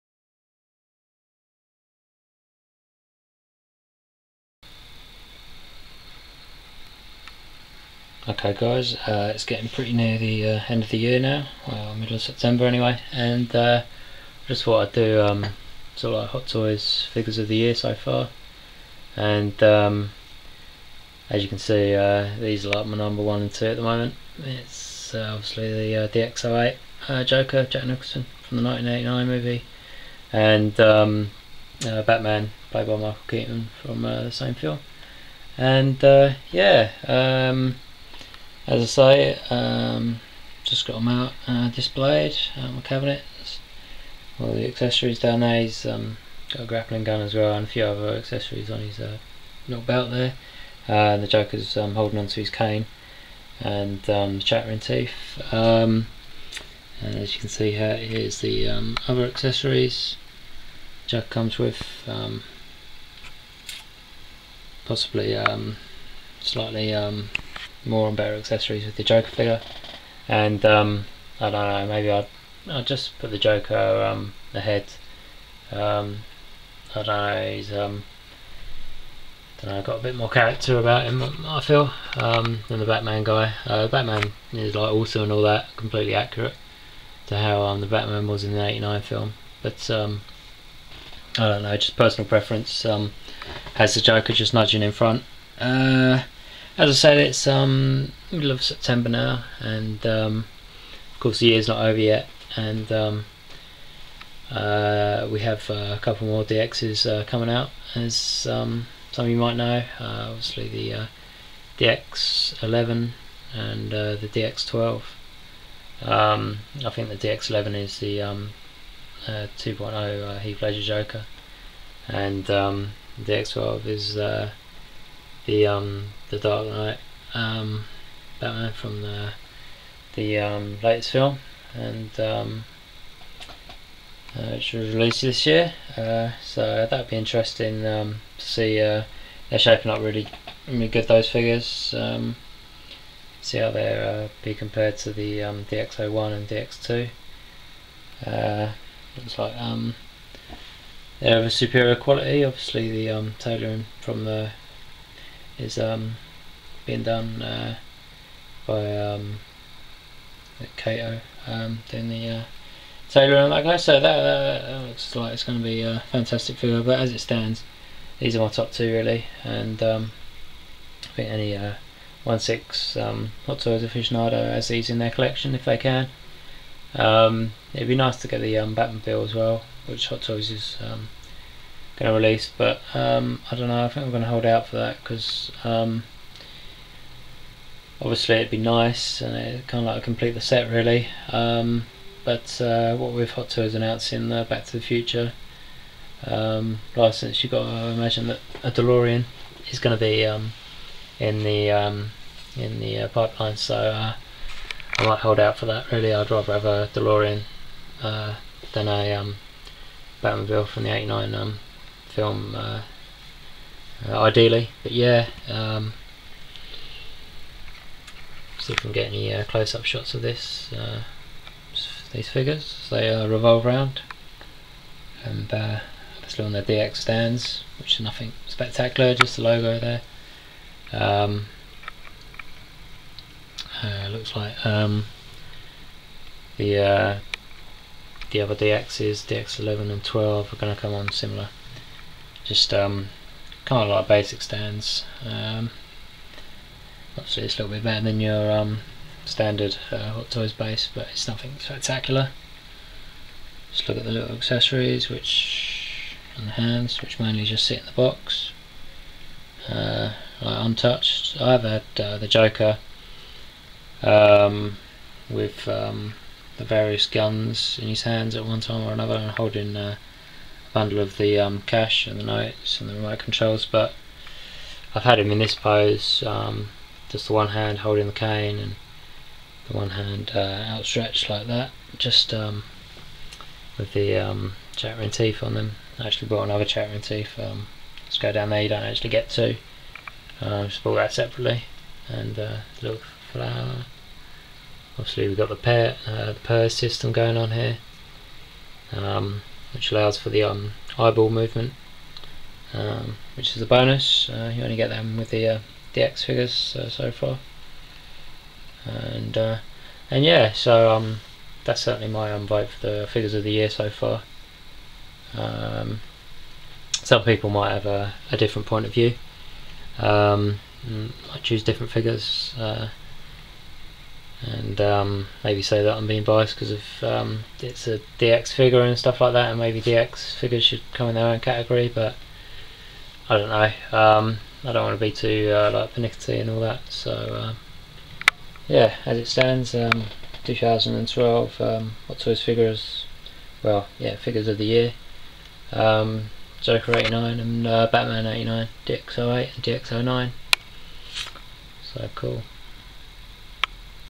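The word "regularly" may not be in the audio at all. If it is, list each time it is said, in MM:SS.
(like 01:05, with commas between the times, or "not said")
not said.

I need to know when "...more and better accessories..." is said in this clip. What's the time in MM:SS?
01:07.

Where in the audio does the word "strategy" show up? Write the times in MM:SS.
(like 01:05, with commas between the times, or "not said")
not said.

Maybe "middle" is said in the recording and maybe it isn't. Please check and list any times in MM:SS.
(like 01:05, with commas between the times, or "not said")
00:11, 01:38.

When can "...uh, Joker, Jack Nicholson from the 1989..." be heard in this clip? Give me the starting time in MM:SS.
00:27.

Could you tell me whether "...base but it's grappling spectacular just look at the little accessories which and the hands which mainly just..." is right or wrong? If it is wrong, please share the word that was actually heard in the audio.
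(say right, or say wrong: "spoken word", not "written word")
wrong: "nothing", not "grappling".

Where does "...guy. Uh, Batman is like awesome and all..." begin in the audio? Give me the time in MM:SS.
01:23.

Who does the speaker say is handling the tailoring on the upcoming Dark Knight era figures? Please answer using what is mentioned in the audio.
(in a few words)
Kato.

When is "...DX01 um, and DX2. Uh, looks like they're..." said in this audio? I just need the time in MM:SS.
02:25.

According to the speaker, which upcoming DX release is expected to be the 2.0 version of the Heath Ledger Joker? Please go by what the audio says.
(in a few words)
DX11.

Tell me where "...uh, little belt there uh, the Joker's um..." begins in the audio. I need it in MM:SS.
00:48.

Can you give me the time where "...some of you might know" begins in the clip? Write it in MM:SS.
01:49.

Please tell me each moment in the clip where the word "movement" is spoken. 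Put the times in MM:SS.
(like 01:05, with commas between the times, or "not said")
05:01.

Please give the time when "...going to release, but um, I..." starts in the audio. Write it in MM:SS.
03:02.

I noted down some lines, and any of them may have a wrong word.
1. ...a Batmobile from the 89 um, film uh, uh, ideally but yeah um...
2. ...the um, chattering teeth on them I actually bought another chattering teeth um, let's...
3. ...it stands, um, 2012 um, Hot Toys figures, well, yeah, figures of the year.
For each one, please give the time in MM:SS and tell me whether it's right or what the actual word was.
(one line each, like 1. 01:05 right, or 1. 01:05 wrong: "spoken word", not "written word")
1. 03:28 right
2. 04:43 right
3. 05:39 right.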